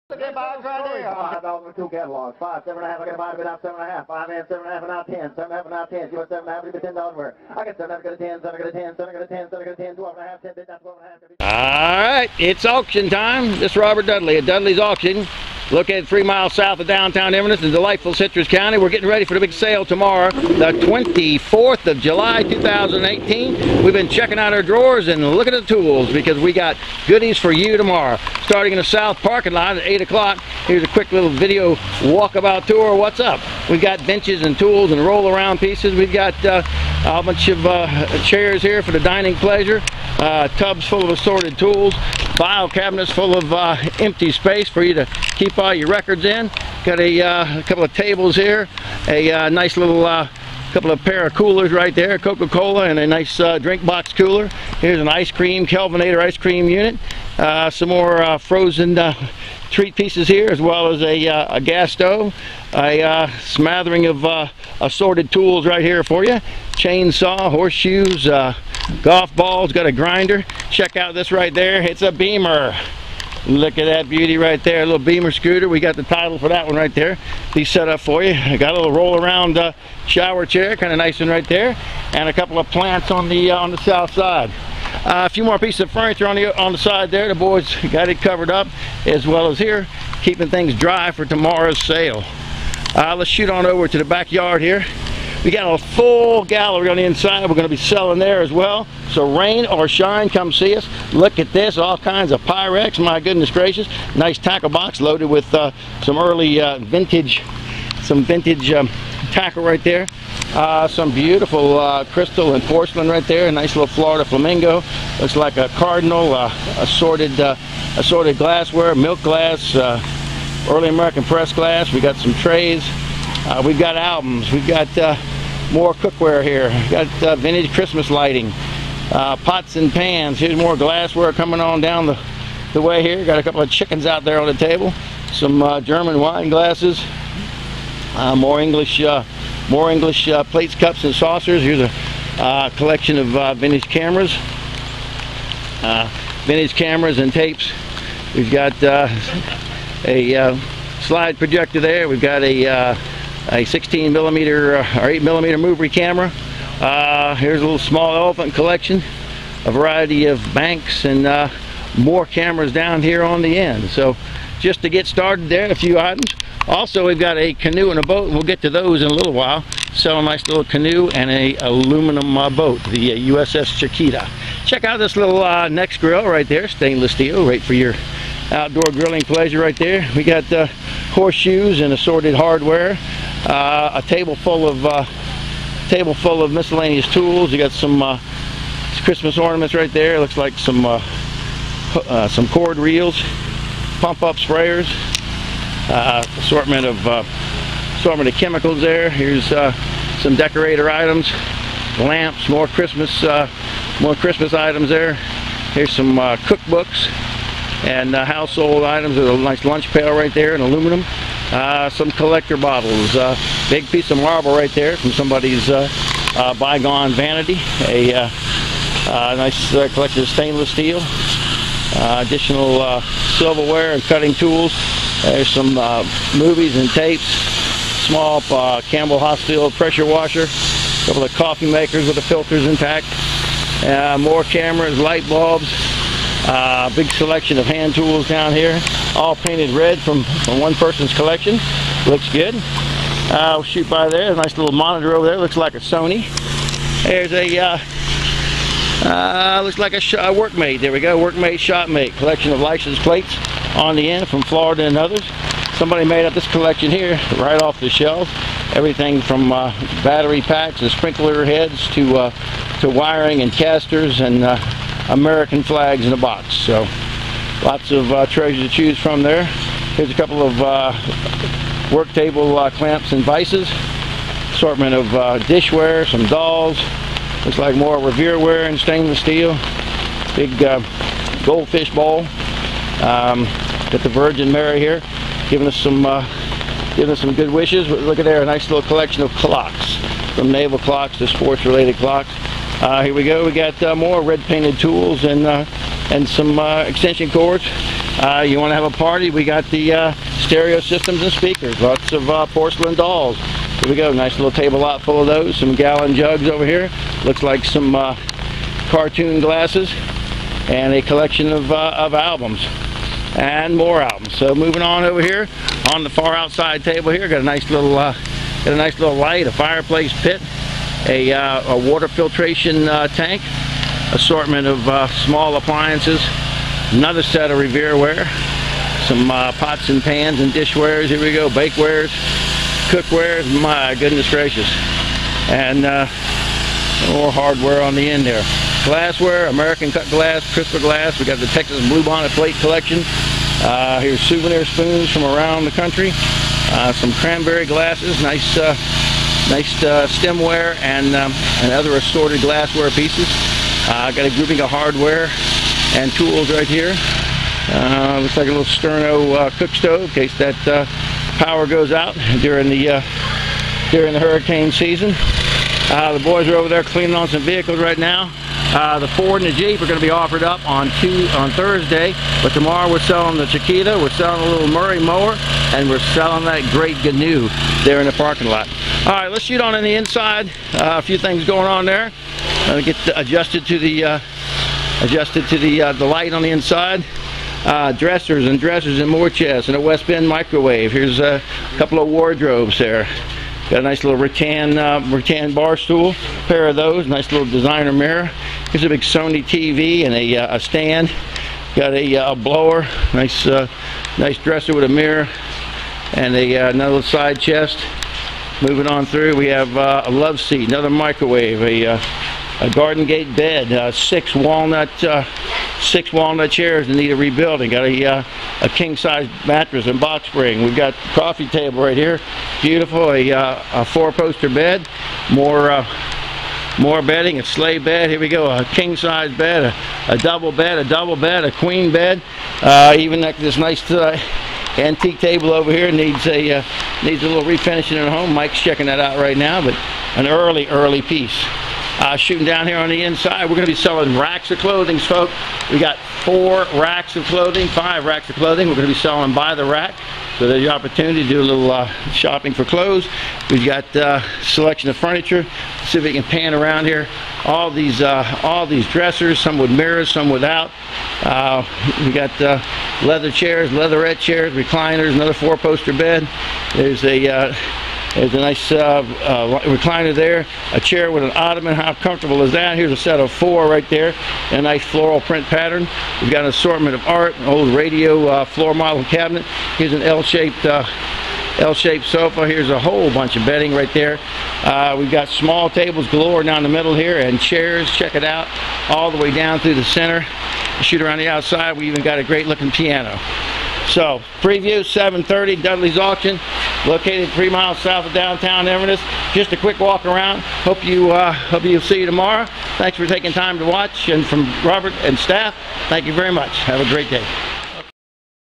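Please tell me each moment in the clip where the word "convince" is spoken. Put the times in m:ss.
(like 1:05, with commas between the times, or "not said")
not said.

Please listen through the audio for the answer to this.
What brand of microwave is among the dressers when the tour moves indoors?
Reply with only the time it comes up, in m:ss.
6:29.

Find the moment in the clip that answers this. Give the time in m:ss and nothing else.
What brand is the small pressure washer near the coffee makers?
3:48.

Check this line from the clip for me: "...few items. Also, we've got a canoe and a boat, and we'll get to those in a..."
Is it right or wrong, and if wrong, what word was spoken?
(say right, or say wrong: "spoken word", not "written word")
right.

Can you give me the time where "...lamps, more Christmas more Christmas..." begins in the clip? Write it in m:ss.
3:21.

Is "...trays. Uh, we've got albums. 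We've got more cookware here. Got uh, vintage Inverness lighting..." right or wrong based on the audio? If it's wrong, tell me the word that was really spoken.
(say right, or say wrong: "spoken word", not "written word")
wrong: "Christmas", not "Inverness".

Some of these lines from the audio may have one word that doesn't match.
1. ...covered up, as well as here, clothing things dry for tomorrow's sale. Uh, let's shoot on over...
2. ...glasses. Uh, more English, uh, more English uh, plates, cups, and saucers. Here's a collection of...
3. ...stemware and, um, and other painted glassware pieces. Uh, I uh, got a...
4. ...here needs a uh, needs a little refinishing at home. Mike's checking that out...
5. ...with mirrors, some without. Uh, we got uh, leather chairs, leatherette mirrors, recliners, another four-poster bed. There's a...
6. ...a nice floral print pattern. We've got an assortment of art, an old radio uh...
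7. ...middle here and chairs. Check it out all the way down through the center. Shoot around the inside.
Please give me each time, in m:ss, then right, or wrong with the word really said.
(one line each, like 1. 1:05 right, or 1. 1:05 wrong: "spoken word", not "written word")
1. 1:28 wrong: "keeping", not "clothing"
2. 2:16 right
3. 5:50 wrong: "assorted", not "painted"
4. 7:15 right
5. 7:39 wrong: "chairs", not "mirrors"
6. 7:54 right
7. 8:06 wrong: "outside", not "inside".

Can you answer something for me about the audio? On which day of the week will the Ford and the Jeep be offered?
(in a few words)
Thursday.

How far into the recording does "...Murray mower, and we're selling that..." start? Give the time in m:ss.
6:14.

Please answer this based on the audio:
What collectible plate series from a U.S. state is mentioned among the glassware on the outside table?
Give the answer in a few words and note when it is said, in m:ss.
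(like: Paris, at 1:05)
Texas Bluebonnet, at 5:41.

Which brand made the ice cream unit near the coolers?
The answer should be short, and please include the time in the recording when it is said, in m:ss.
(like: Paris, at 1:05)
Kelvinator, at 0:55.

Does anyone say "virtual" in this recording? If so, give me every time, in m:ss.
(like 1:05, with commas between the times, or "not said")
not said.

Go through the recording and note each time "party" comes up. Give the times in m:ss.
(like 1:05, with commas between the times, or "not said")
4:58.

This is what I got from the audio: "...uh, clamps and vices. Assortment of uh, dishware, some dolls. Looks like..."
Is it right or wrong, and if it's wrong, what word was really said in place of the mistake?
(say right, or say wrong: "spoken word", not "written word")
right.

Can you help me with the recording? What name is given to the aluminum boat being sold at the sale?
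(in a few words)
USS Chiquita.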